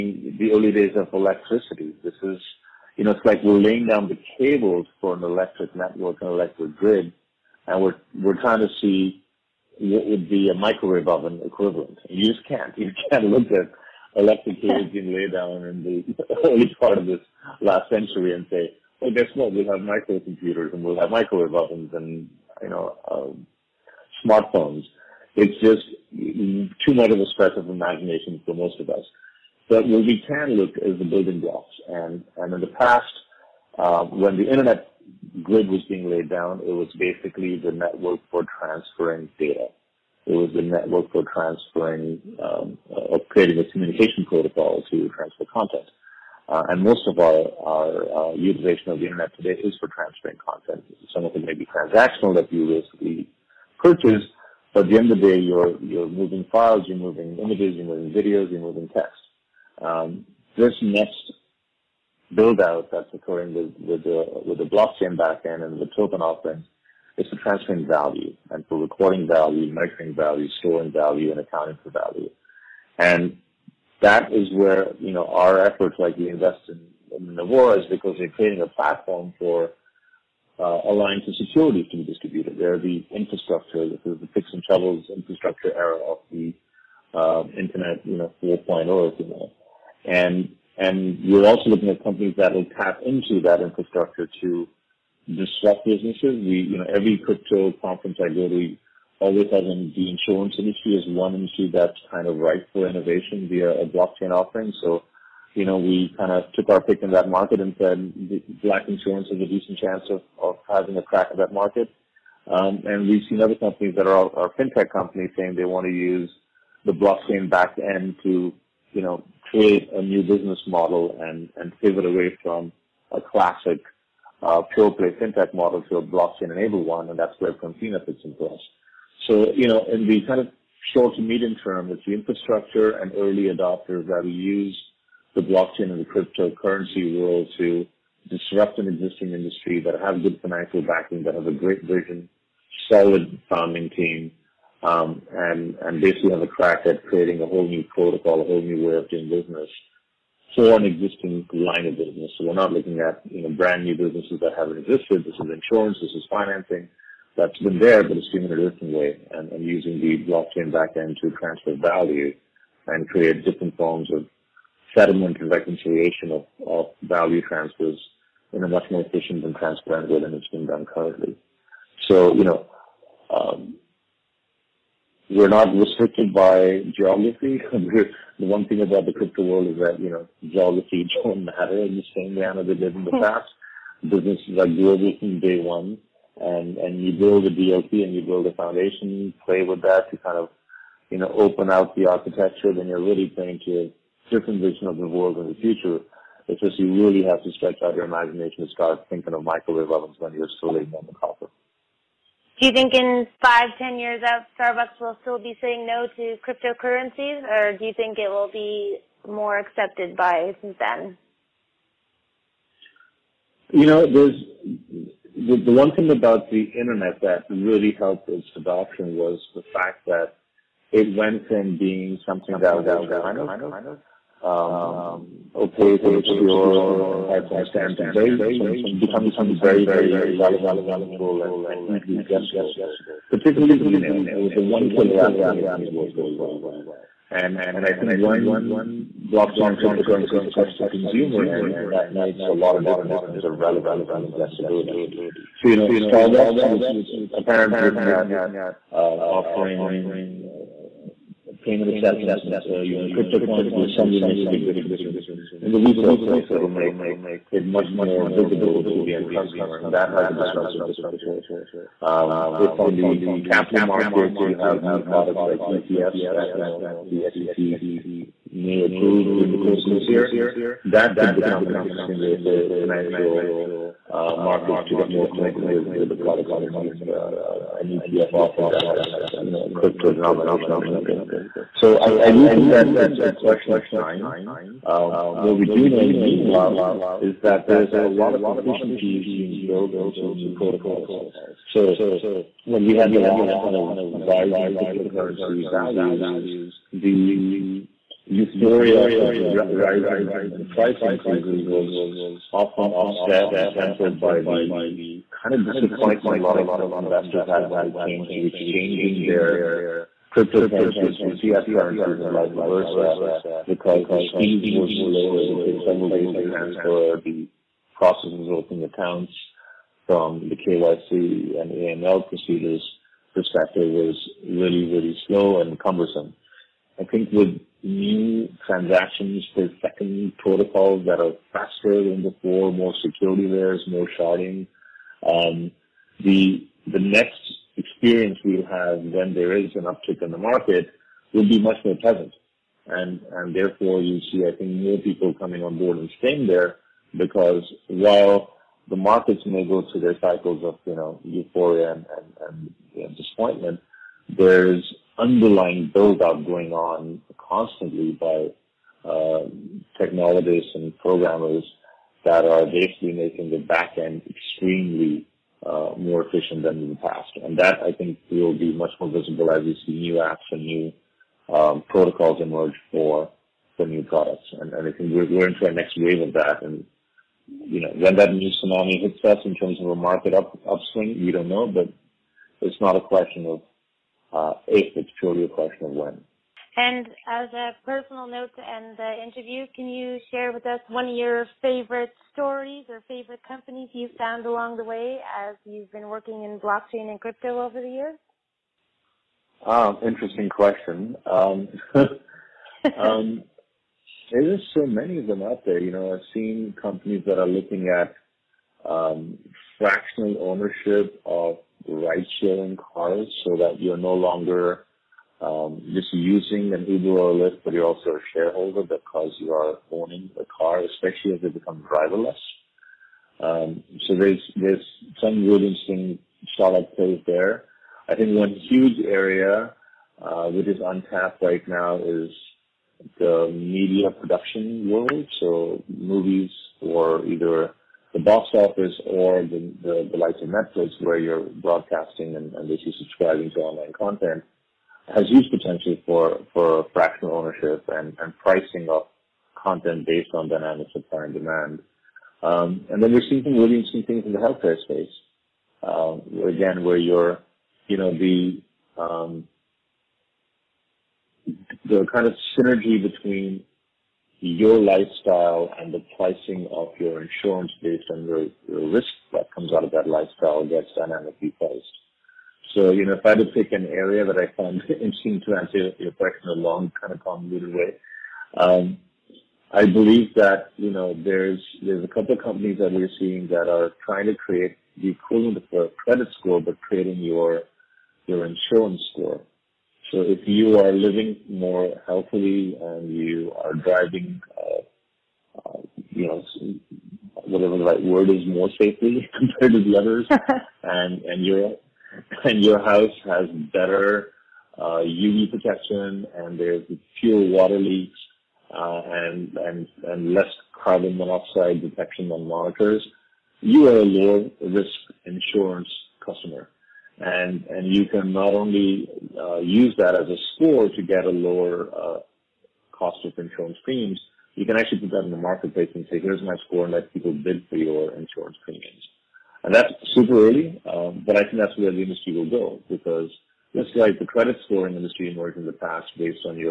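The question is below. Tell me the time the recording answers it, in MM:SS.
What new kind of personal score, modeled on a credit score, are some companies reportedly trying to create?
08:08.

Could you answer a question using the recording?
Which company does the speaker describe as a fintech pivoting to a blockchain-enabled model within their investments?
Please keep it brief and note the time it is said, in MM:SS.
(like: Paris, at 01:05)
Confina, at 02:07.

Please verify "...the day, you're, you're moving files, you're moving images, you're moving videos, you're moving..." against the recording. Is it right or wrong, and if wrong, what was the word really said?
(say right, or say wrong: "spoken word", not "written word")
right.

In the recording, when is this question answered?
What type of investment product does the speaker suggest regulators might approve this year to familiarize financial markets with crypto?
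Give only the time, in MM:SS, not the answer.
04:25.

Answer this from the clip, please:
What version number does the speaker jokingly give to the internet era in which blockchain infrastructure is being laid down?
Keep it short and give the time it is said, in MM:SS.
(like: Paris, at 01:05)
4.0, at 01:28.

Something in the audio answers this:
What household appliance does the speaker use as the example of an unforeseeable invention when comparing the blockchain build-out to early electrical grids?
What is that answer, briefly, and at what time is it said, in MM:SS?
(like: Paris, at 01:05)
microwave oven, at 00:10.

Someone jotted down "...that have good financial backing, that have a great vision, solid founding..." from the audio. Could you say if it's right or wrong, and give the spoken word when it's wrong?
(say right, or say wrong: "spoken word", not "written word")
right.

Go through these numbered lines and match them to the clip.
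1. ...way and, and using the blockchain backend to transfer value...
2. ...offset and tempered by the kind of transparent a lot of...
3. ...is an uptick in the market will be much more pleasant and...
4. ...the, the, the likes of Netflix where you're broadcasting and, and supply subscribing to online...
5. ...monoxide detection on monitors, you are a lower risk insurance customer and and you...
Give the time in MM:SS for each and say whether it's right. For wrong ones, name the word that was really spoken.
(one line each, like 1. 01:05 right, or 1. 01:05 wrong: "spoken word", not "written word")
1. 02:38 right
2. 05:02 wrong: "disappointment", not "transparent"
3. 05:39 right
4. 07:19 wrong: "basically", not "supply"
5. 08:31 right.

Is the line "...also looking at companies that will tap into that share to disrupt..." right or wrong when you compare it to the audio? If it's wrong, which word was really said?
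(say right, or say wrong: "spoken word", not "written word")
wrong: "infrastructure", not "share".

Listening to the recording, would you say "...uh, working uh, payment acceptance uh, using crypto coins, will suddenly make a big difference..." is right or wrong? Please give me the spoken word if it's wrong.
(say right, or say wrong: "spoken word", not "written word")
wrong: "offering", not "working".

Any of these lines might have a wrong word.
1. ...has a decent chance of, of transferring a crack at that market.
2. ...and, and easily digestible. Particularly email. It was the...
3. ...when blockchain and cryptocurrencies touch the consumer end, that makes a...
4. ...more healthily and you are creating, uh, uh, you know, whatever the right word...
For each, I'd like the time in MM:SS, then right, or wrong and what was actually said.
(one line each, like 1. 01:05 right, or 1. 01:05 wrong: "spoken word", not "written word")
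1. 01:49 wrong: "having", not "transferring"
2. 03:51 right
3. 03:58 right
4. 08:11 wrong: "driving", not "creating".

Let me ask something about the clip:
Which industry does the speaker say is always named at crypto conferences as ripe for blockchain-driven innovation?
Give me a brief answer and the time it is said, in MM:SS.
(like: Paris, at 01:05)
insurance industry, at 01:40.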